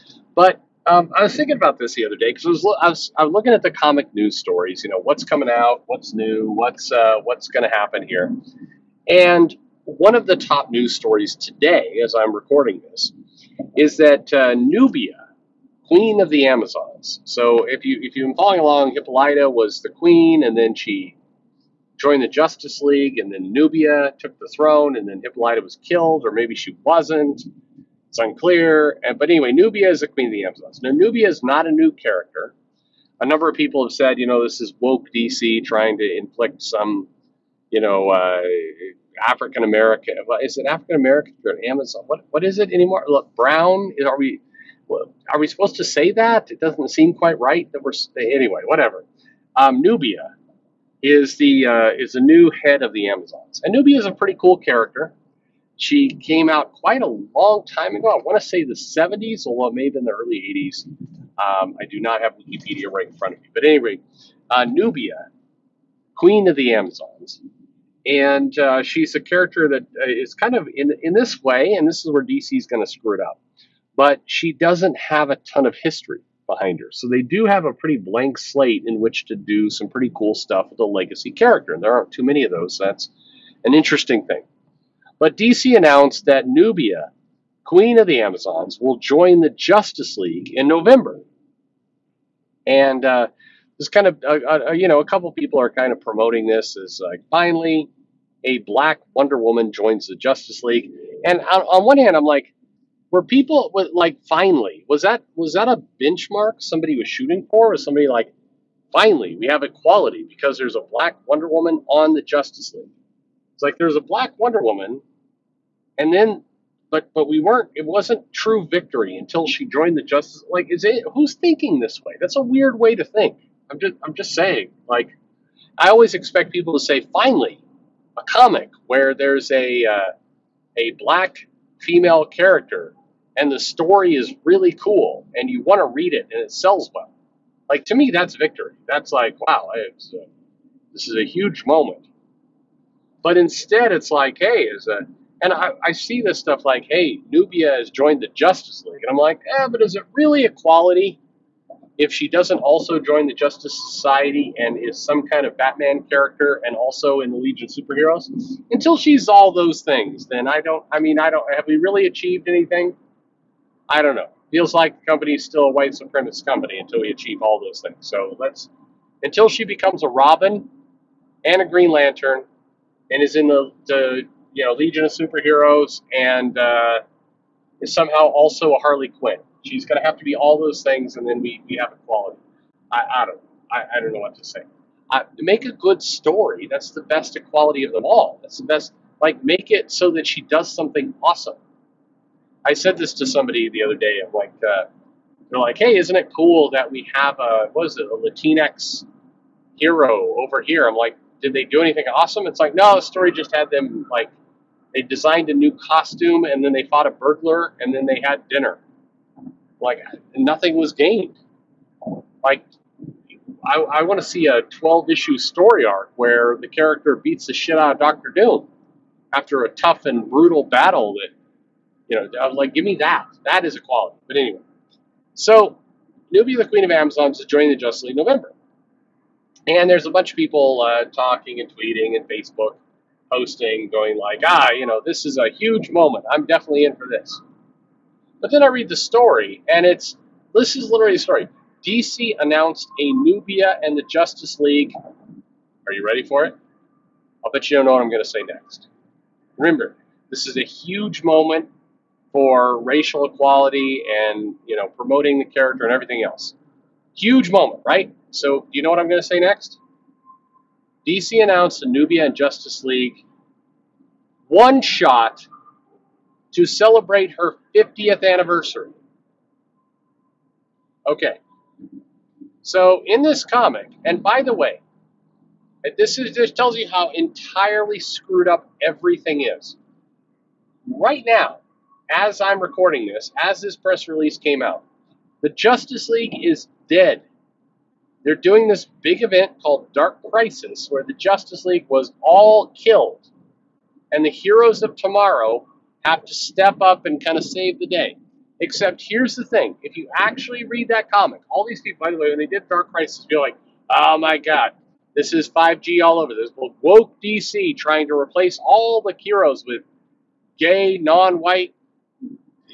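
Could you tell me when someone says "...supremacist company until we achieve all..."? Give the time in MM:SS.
02:45.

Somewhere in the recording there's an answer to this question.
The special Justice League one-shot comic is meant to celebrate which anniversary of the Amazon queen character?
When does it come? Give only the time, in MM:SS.
04:27.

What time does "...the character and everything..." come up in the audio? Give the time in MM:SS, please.
04:15.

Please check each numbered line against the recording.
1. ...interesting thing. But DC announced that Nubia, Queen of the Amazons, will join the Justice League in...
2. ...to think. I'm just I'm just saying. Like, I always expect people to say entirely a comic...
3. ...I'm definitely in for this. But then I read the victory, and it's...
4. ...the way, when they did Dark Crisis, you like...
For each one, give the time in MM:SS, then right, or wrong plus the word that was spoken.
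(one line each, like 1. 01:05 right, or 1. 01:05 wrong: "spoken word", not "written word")
1. 01:23 right
2. 02:02 wrong: "finally", not "entirely"
3. 03:56 wrong: "story", not "victory"
4. 05:02 right.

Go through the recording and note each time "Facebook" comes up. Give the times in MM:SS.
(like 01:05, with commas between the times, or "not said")
03:52.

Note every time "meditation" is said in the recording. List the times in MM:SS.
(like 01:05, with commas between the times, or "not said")
not said.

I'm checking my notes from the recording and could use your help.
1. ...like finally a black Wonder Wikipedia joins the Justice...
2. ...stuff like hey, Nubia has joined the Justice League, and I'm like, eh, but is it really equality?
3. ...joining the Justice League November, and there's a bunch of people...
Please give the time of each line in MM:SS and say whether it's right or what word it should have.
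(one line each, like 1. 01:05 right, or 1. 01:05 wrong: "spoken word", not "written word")
1. 01:37 wrong: "Woman", not "Wikipedia"
2. 02:26 right
3. 03:47 right.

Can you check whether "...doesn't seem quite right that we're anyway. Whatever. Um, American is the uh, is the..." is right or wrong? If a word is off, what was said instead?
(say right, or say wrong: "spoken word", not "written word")
wrong: "Nubia", not "American".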